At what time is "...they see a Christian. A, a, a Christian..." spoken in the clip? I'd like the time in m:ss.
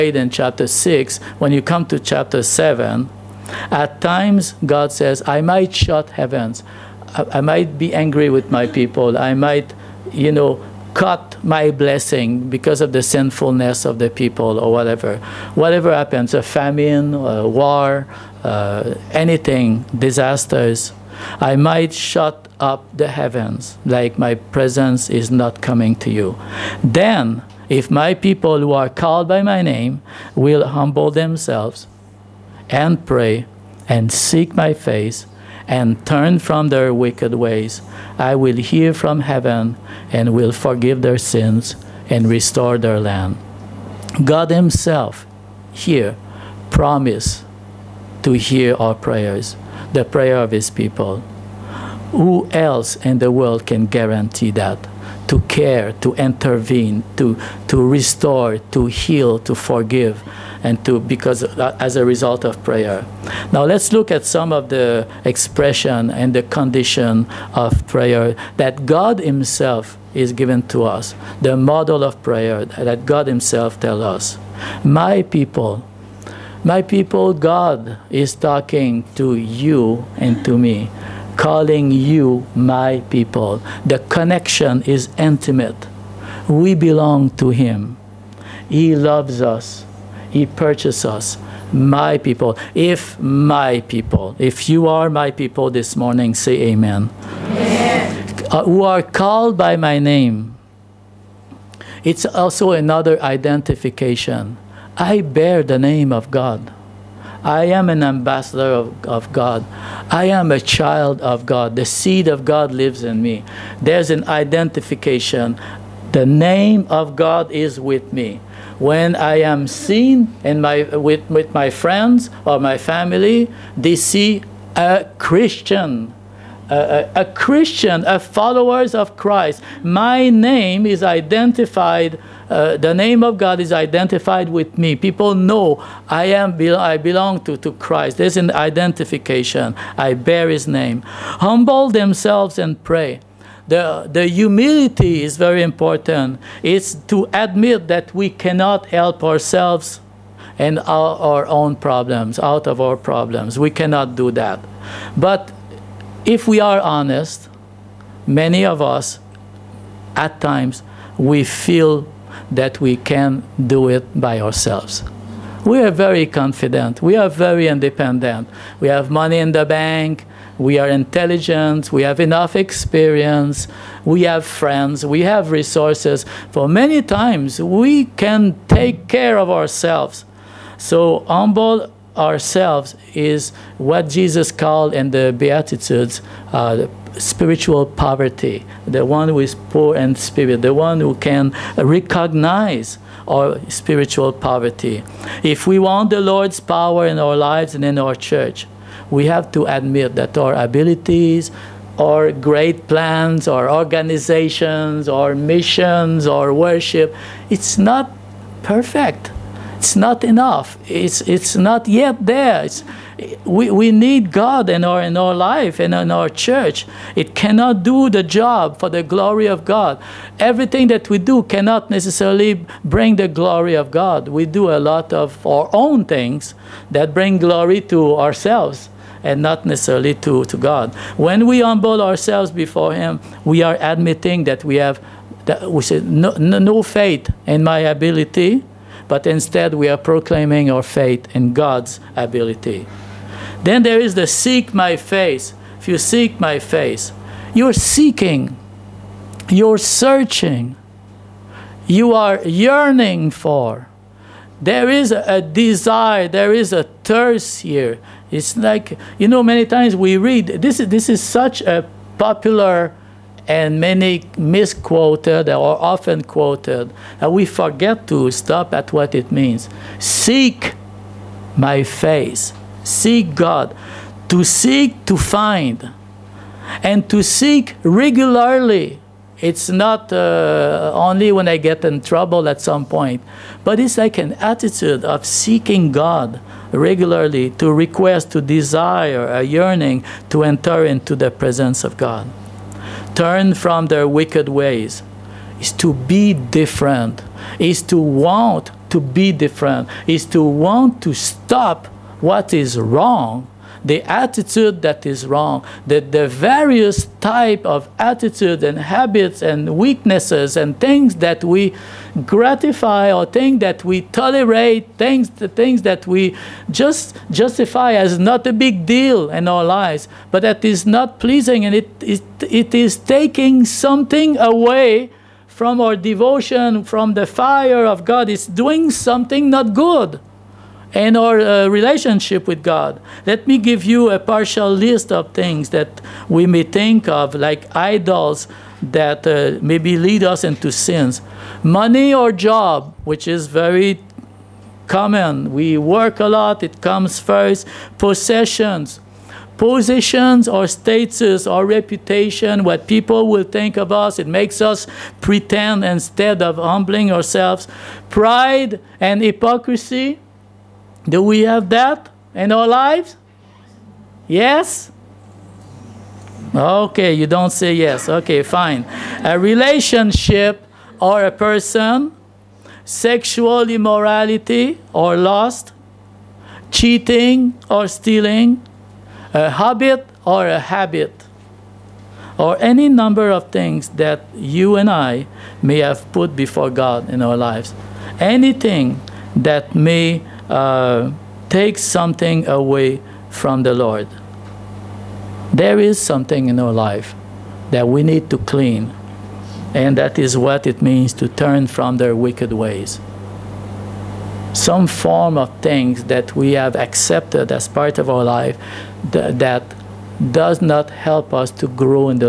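2:03.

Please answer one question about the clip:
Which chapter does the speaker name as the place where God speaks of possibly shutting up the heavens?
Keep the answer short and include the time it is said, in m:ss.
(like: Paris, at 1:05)
chapter 7, at 0:01.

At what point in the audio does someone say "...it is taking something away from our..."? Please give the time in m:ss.
5:22.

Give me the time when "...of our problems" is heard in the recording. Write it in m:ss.
2:32.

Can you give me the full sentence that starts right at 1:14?
My people, my people, God is talking to you and to me, calling you my people.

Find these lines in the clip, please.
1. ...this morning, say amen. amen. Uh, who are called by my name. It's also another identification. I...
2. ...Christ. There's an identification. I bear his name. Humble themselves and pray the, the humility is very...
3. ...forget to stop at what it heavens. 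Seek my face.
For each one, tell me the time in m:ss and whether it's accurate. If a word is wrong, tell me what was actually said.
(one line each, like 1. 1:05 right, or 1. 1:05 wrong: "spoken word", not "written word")
1. 1:35 right
2. 2:17 right
3. 4:27 wrong: "means", not "heavens".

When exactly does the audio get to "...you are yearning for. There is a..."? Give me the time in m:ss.
4:11.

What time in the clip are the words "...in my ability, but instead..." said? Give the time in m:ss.
3:57.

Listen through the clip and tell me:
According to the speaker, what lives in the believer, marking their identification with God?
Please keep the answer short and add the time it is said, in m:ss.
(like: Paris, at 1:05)
The seed of God, at 1:51.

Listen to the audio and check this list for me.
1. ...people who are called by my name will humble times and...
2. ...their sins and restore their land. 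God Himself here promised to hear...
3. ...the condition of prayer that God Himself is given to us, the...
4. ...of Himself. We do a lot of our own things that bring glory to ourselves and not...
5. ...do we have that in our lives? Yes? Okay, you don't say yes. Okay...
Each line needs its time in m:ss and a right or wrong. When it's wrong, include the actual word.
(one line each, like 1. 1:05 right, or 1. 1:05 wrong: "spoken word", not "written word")
1. 0:28 wrong: "themselves", not "times"
2. 0:41 right
3. 1:06 right
4. 3:43 wrong: "God", not "Himself"
5. 6:01 right.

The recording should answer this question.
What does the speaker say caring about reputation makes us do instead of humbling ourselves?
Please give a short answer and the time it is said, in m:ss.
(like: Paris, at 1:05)
pretend, at 5:55.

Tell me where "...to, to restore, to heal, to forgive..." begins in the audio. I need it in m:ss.
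0:57.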